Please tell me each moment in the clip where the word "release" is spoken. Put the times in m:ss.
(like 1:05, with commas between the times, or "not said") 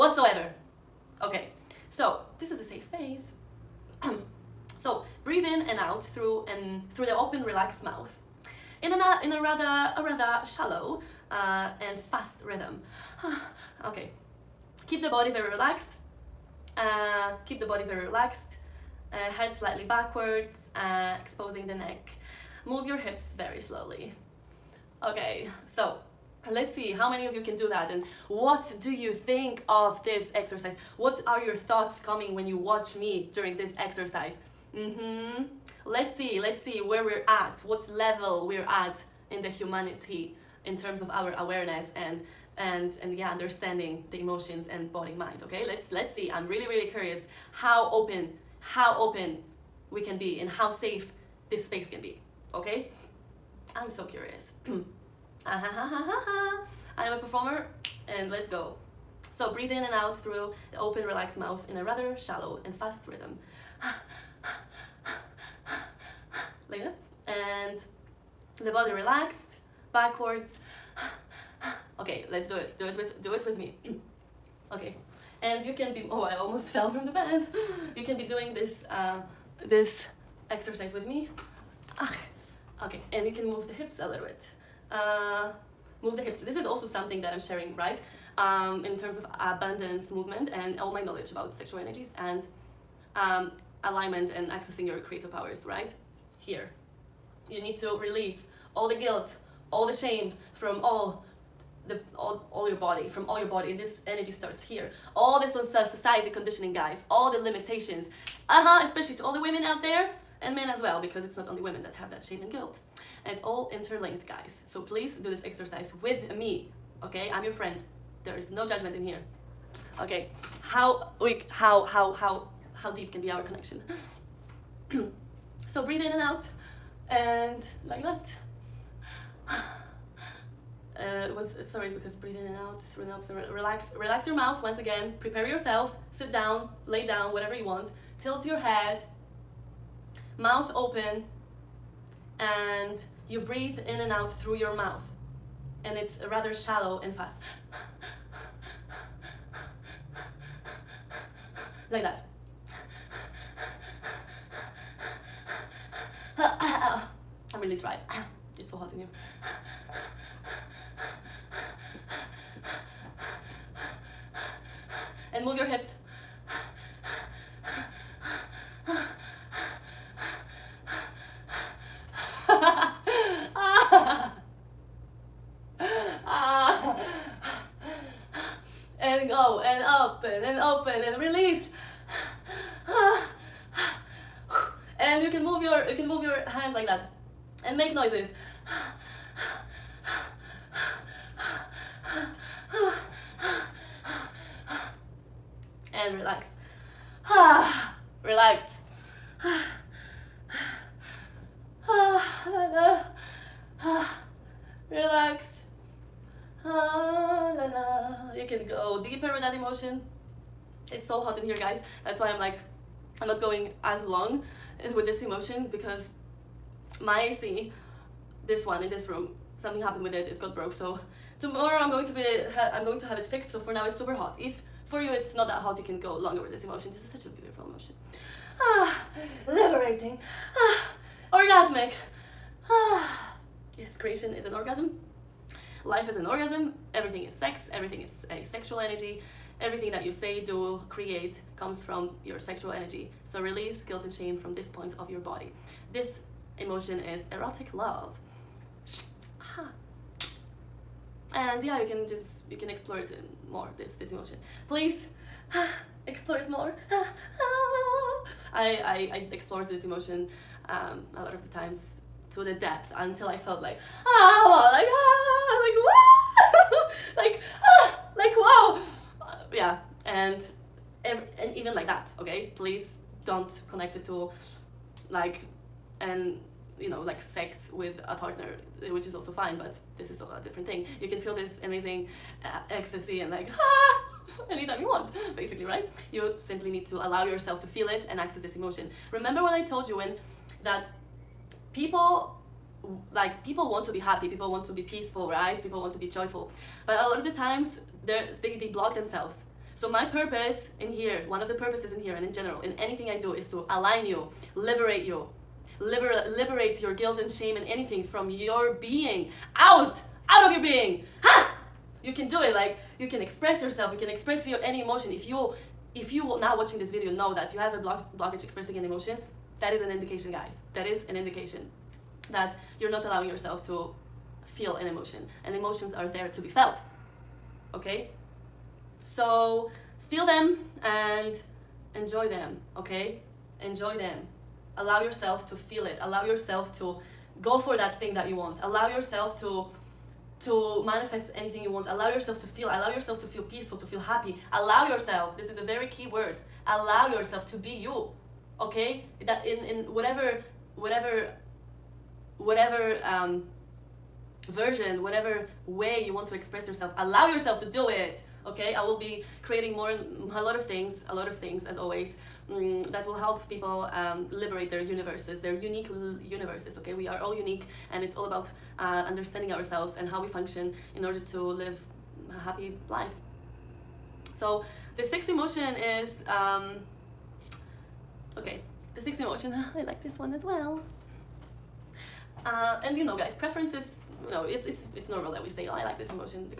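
1:38, 4:03.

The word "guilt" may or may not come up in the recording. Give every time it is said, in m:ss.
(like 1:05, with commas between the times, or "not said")
1:38, 1:52, 4:03, 5:06.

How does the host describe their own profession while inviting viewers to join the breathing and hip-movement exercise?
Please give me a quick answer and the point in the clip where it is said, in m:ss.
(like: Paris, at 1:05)
a performer, at 0:57.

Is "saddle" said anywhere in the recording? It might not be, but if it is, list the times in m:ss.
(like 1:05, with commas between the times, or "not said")
not said.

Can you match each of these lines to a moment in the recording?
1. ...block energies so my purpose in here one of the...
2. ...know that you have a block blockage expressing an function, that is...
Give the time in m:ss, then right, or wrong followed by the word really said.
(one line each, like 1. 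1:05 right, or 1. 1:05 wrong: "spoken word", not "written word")
1. 4:58 wrong: "themselves", not "energies"
2. 5:17 wrong: "emotion", not "function".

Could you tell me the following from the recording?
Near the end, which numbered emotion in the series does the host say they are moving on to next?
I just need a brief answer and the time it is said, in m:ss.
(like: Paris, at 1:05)
sixth, at 6:15.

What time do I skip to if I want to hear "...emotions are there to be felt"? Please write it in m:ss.
5:25.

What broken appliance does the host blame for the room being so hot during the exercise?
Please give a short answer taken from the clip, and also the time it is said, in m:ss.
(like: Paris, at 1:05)
AC, at 3:37.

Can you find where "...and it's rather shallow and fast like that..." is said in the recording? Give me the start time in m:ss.
2:25.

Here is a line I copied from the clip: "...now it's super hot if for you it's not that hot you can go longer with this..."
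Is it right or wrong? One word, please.
right.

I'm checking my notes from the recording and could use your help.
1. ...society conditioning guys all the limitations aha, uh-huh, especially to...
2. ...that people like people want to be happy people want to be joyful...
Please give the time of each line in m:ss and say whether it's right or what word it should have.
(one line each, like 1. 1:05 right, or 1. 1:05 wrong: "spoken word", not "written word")
1. 1:45 right
2. 4:50 wrong: "peaceful", not "joyful".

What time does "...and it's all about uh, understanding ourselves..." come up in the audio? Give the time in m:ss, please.
6:07.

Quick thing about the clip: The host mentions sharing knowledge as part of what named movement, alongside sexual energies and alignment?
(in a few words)
abundance movement.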